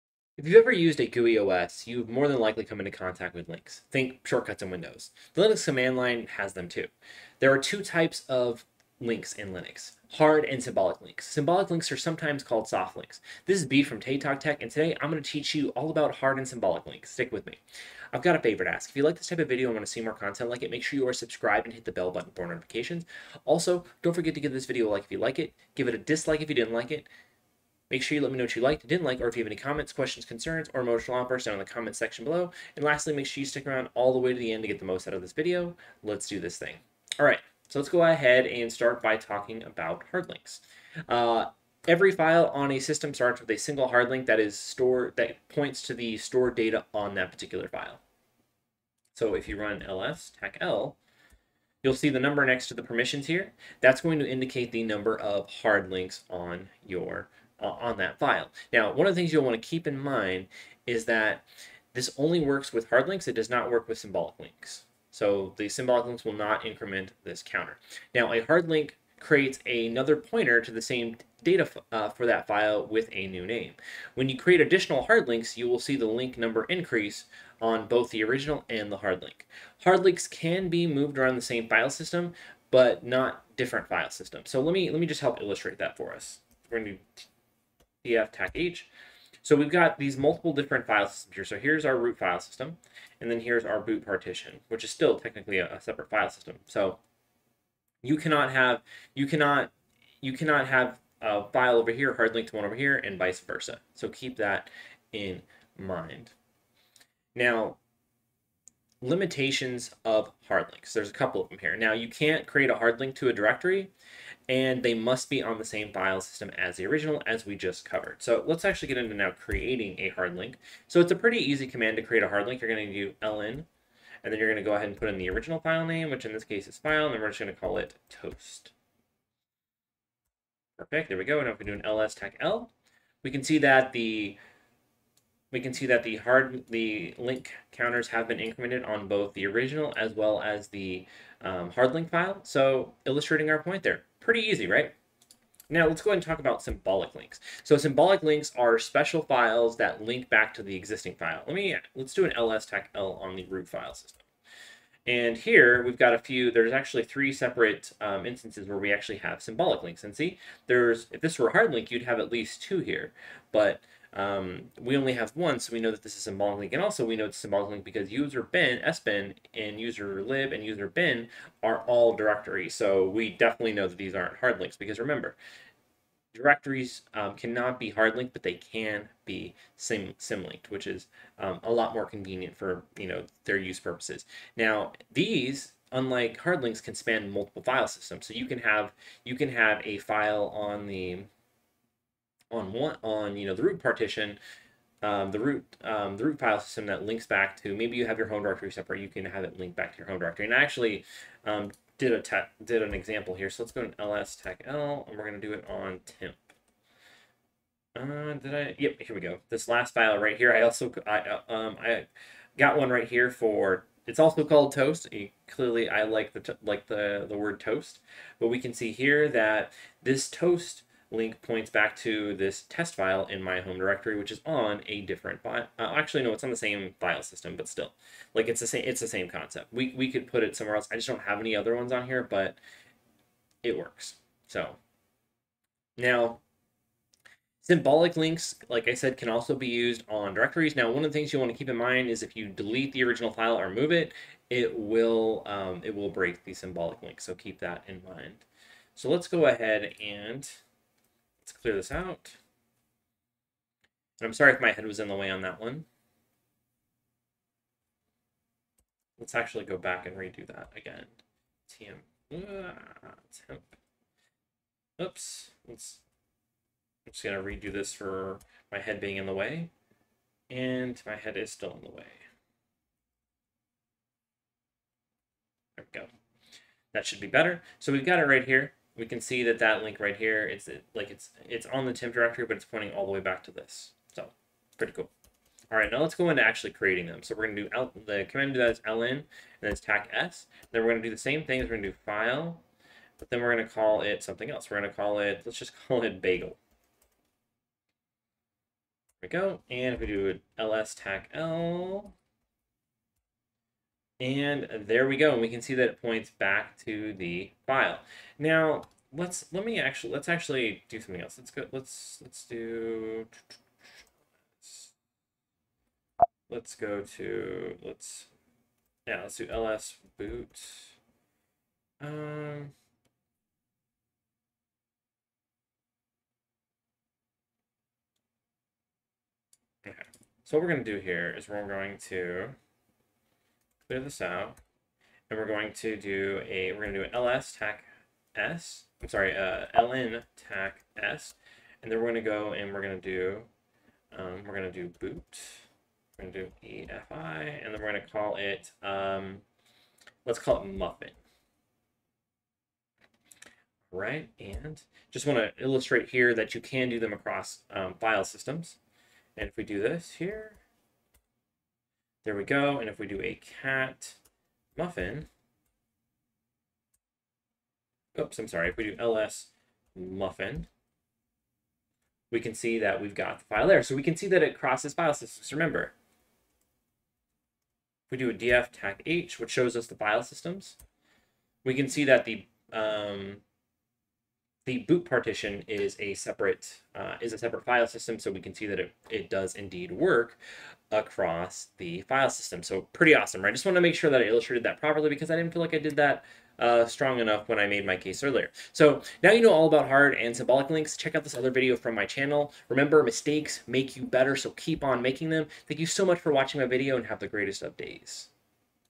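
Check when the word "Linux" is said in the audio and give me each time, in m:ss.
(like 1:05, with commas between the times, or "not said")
0:05, 0:09.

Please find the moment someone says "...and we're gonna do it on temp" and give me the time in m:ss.
3:25.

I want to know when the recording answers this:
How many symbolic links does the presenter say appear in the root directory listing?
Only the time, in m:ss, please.
2:37.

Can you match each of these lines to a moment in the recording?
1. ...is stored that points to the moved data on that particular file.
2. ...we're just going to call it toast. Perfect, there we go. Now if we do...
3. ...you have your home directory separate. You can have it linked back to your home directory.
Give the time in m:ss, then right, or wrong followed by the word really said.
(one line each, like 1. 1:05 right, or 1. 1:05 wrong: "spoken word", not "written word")
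1. 0:44 wrong: "stored", not "moved"
2. 2:07 right
3. 3:17 right.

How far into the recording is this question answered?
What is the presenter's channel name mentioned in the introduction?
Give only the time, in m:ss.
0:13.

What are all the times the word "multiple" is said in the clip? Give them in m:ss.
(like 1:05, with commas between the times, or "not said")
1:30, 3:07.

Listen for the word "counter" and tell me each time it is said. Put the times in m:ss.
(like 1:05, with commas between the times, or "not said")
1:07, 2:17.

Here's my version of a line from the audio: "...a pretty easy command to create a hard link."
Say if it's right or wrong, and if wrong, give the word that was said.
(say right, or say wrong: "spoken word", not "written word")
right.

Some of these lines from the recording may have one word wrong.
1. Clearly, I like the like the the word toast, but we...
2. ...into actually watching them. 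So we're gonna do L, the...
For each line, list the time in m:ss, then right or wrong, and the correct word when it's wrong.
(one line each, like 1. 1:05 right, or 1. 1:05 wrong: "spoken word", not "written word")
1. 3:35 right
2. 4:46 wrong: "creating", not "watching".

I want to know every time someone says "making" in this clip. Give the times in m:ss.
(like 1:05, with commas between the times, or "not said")
6:45.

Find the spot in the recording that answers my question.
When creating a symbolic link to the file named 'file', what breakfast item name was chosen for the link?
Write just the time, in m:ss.
4:55.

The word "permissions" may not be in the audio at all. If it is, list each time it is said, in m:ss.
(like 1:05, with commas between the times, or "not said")
0:52.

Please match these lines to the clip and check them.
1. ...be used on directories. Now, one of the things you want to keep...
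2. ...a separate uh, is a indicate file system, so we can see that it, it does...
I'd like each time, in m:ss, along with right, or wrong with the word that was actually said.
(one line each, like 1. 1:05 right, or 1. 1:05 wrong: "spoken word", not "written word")
1. 3:59 right
2. 6:25 wrong: "separate", not "indicate".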